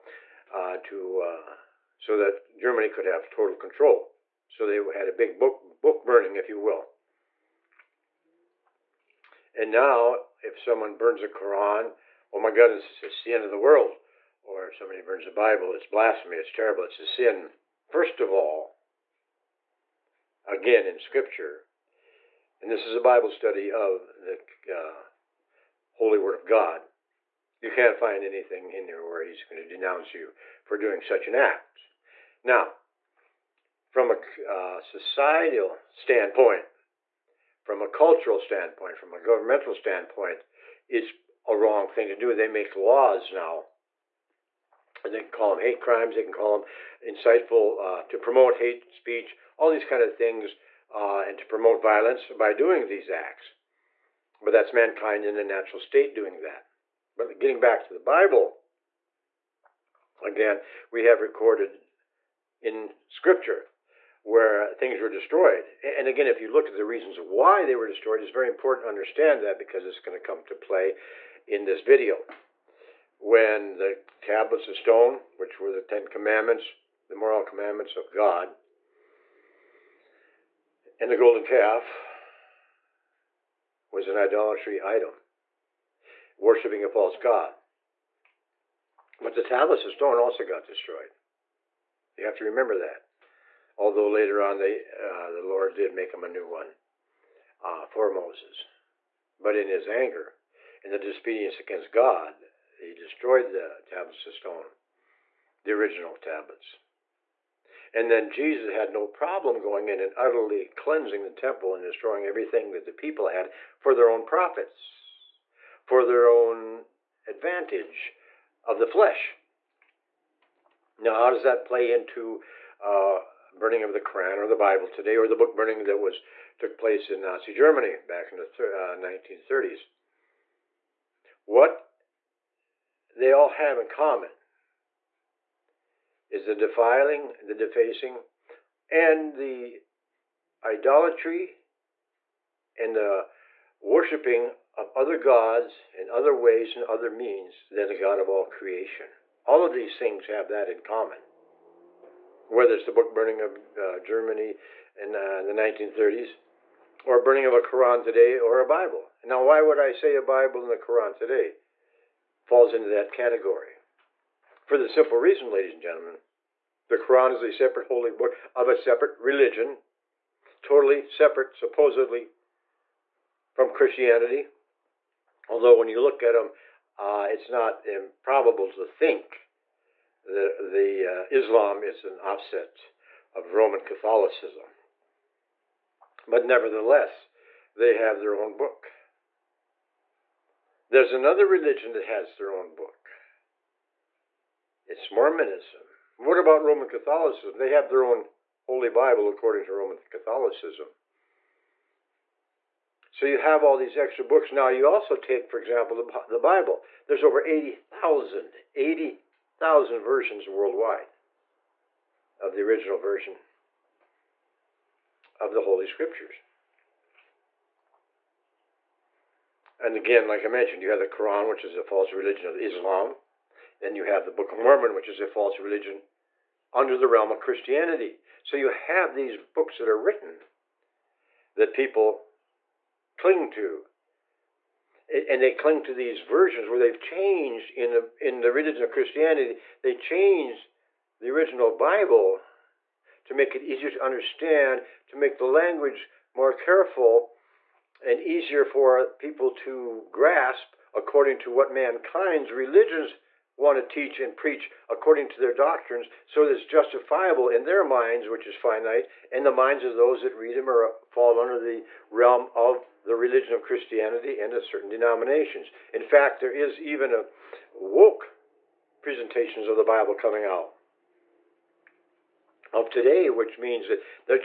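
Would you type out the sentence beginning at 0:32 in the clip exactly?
Now, from a uh, societal standpoint, from a cultural standpoint, from a governmental standpoint, it's a wrong thing to do.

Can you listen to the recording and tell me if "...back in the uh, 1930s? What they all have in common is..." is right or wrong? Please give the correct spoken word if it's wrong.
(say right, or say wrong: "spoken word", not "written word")
right.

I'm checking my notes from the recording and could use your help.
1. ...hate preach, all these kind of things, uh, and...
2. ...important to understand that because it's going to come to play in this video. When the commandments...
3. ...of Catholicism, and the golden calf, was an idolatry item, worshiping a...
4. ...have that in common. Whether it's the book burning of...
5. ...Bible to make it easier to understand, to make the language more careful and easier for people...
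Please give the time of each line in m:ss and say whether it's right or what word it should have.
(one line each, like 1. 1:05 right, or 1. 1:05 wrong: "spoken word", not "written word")
1. 0:48 wrong: "speech", not "preach"
2. 1:08 wrong: "tablets", not "commandments"
3. 1:17 wrong: "God", not "Catholicism"
4. 2:30 right
5. 4:01 right.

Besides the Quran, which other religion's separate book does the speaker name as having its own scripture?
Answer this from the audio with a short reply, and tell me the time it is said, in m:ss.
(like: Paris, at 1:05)
Mormonism, at 3:15.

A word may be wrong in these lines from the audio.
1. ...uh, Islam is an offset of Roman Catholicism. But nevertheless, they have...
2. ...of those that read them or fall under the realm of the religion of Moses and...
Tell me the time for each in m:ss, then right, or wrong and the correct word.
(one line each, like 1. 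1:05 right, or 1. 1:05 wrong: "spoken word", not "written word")
1. 3:01 right
2. 4:19 wrong: "Christianity", not "Moses".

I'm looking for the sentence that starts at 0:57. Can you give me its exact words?
But getting back to the Bible, again, we have recorded in Scripture where things were destroyed.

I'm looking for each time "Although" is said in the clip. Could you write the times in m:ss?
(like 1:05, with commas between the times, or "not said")
1:33, 2:55.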